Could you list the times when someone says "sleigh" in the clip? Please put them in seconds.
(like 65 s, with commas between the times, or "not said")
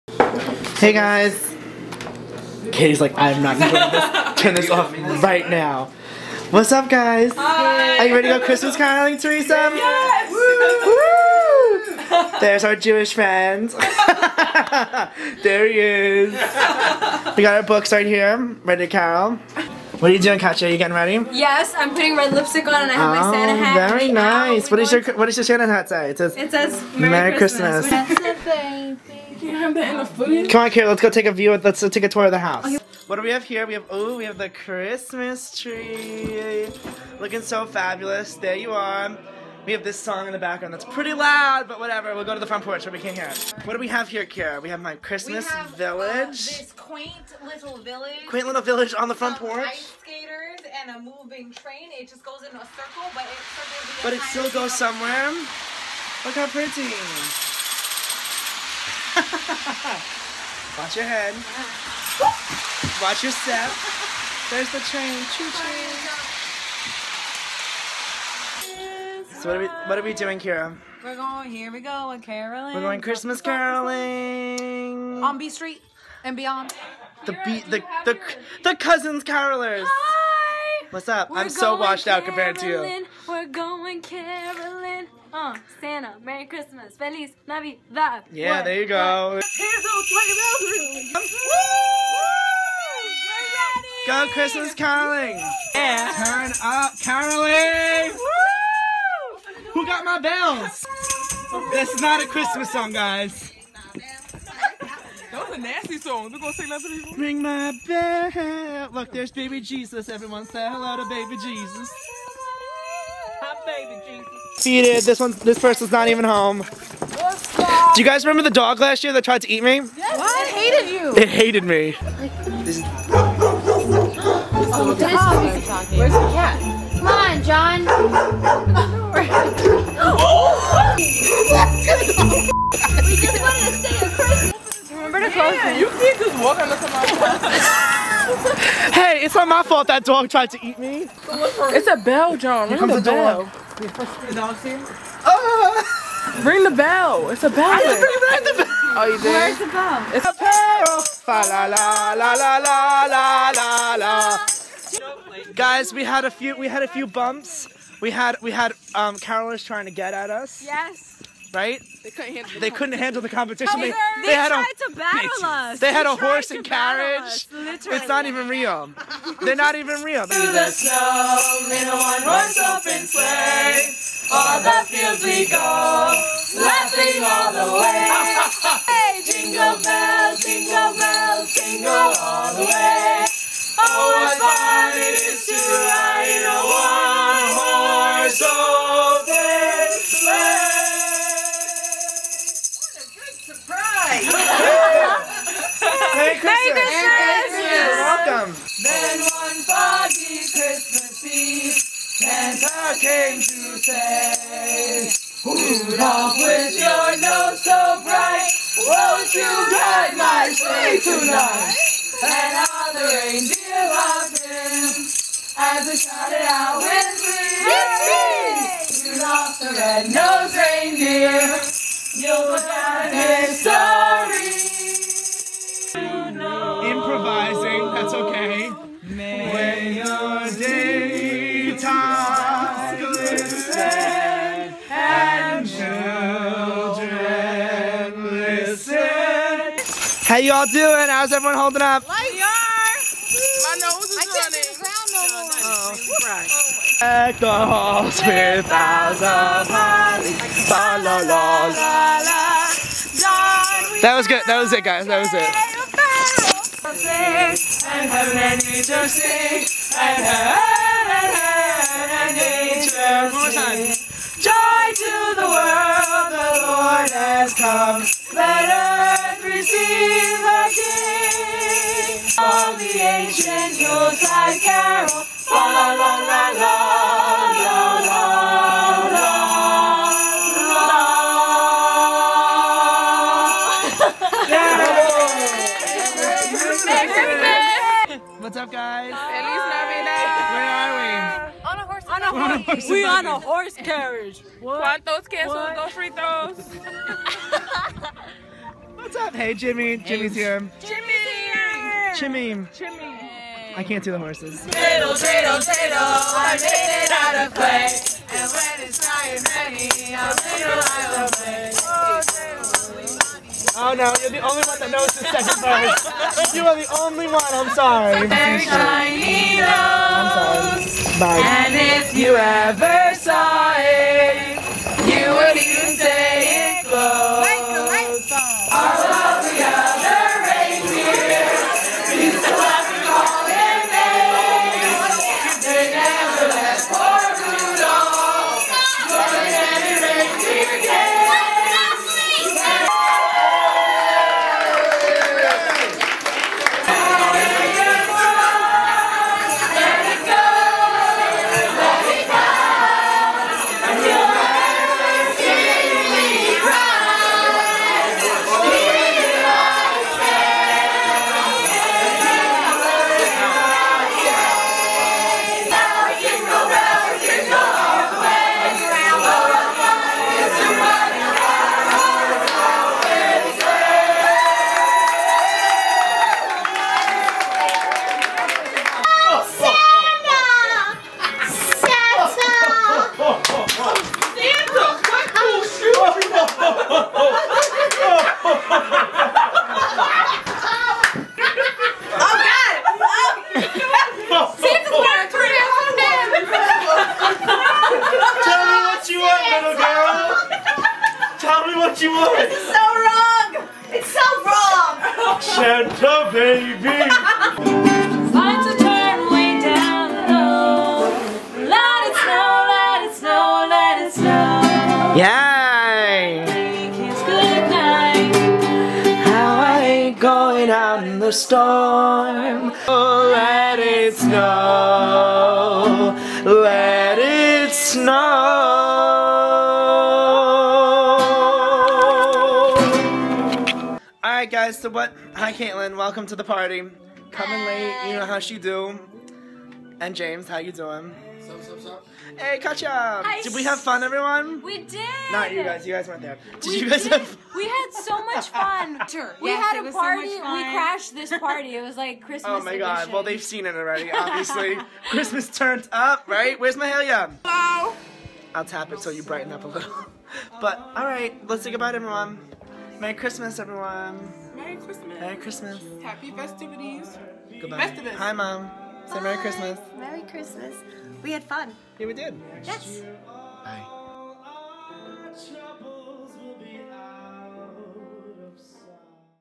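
173 s, 210 s.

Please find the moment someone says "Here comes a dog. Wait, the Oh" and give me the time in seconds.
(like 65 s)
142 s.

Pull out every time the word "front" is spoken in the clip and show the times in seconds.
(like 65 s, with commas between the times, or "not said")
42 s, 49 s.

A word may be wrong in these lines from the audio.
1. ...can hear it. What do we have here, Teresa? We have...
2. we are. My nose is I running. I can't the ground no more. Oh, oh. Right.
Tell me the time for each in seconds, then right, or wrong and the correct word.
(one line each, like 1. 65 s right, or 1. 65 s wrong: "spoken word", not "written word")
1. 42 s wrong: "Kara", not "Teresa"
2. 242 s right.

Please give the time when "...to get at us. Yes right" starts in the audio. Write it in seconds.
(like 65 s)
159 s.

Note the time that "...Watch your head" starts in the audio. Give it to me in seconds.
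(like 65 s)
60 s.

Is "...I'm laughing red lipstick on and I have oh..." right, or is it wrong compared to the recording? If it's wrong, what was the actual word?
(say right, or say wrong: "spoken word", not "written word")
wrong: "putting", not "laughing".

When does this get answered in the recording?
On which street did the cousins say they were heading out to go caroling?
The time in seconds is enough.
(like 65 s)
75 s.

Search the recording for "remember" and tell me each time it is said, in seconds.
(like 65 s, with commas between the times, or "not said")
118 s, 134 s.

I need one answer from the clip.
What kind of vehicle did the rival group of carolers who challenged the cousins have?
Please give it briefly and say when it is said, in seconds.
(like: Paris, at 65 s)
Horse and carriage, at 166 s.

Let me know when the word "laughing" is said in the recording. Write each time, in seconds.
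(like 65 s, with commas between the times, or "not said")
176 s.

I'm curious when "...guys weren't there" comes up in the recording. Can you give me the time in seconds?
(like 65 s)
445 s.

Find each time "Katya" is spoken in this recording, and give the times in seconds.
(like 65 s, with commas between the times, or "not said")
20 s, 442 s.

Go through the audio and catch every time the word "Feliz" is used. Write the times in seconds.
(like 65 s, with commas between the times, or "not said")
86 s.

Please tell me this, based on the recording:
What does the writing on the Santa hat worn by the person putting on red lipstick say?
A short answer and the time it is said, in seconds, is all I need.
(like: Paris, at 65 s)
Merry, Merry Christmas, at 26 s.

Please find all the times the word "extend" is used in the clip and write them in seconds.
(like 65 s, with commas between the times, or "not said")
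not said.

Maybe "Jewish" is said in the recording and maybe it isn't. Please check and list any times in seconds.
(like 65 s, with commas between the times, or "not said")
12 s.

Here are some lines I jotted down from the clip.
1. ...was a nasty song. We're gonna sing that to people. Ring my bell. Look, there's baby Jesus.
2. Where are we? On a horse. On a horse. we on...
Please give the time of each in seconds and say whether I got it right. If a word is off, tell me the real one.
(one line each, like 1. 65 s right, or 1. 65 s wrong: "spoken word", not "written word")
1. 105 s right
2. 289 s right.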